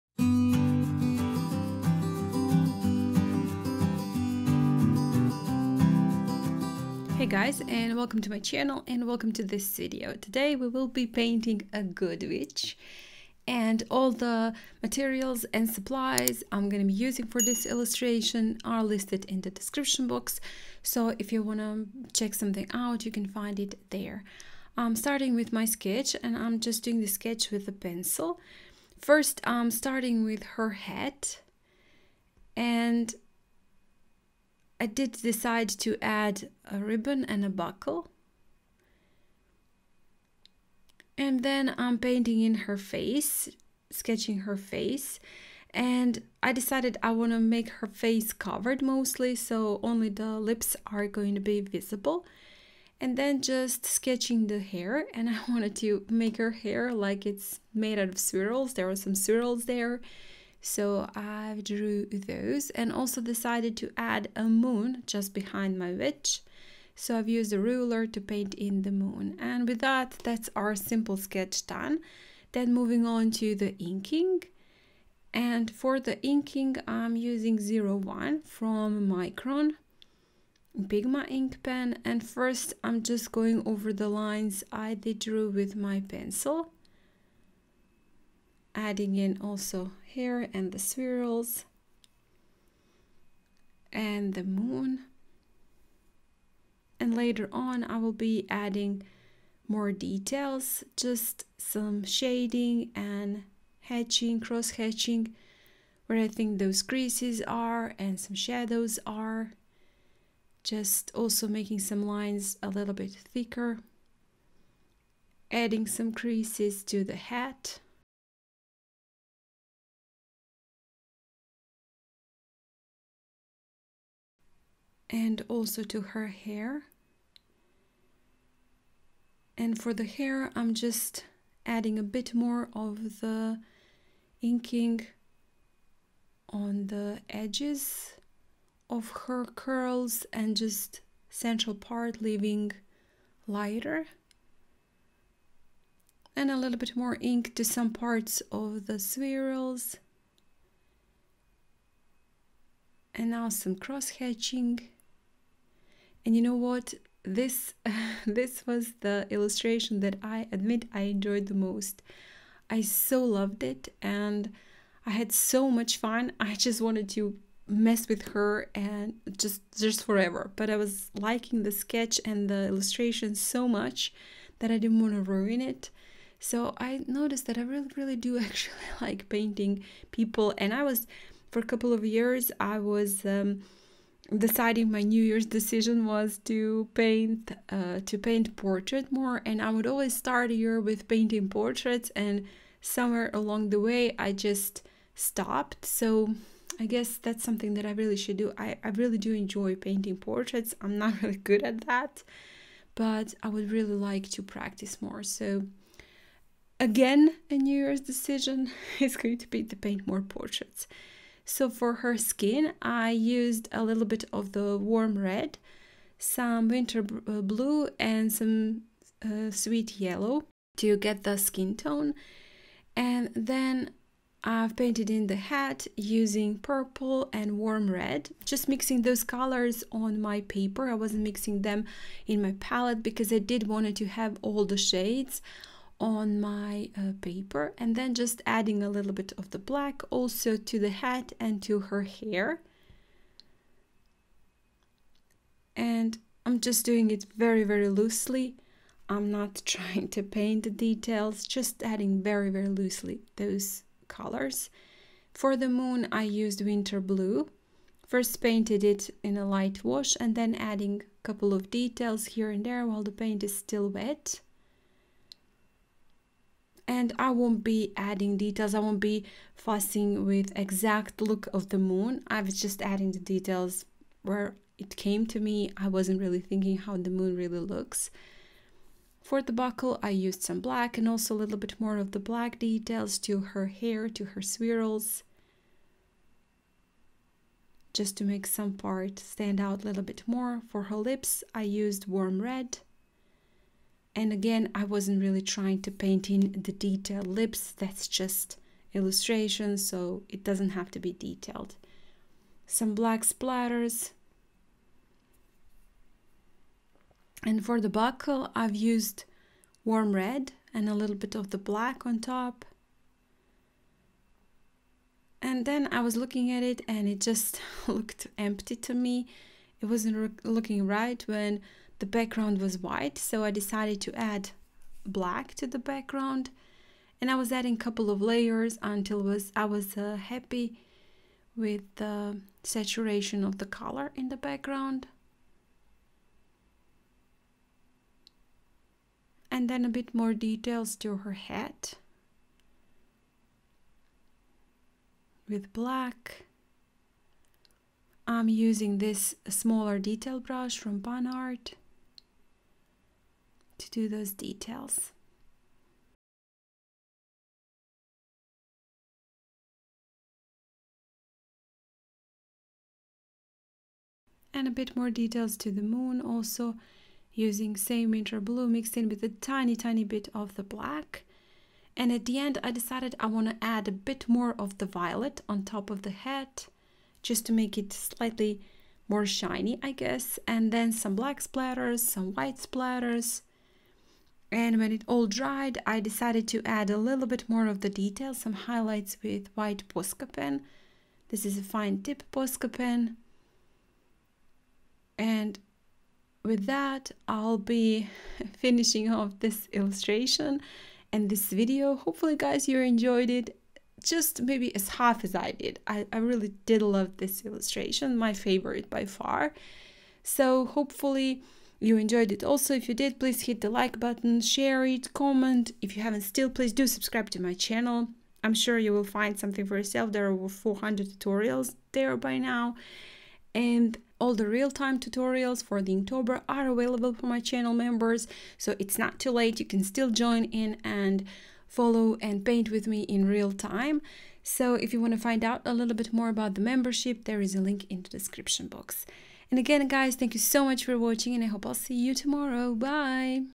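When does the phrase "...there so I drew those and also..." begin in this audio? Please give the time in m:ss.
0:59.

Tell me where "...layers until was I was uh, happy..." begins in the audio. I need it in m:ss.
5:28.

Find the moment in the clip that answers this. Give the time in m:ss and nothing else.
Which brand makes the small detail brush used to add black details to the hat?
5:50.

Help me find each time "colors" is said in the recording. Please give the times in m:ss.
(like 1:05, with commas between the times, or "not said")
3:49, 4:14, 5:33.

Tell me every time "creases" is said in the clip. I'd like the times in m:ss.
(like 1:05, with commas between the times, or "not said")
1:46, 1:56.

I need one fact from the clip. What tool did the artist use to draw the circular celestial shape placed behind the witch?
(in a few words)
A ruler.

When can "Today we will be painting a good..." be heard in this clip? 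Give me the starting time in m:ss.
0:10.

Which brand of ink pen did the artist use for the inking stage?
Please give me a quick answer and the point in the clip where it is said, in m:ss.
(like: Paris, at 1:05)
Micron Pigma, at 1:19.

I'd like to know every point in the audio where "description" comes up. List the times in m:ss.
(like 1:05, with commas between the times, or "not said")
0:19, 7:18.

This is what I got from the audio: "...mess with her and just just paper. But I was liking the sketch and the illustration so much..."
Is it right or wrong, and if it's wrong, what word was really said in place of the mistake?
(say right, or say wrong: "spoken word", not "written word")
wrong: "forever", not "paper".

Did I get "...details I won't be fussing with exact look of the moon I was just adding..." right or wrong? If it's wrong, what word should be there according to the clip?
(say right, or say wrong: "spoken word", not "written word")
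right.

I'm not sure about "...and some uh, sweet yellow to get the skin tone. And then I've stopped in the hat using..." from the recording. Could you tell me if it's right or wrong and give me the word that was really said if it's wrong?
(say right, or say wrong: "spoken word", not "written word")
wrong: "painted", not "stopped".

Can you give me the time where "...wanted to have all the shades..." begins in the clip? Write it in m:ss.
3:53.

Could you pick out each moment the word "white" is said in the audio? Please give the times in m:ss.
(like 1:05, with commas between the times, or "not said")
5:22, 6:22, 6:29.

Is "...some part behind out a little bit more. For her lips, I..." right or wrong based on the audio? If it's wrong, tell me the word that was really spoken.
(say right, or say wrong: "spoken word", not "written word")
wrong: "stand", not "behind".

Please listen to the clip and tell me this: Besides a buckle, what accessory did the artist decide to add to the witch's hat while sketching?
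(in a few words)
A ribbon.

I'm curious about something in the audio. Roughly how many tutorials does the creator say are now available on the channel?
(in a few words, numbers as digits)
Over 400.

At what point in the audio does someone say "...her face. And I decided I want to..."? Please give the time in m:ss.
0:44.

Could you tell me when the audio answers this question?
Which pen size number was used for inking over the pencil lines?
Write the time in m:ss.
1:17.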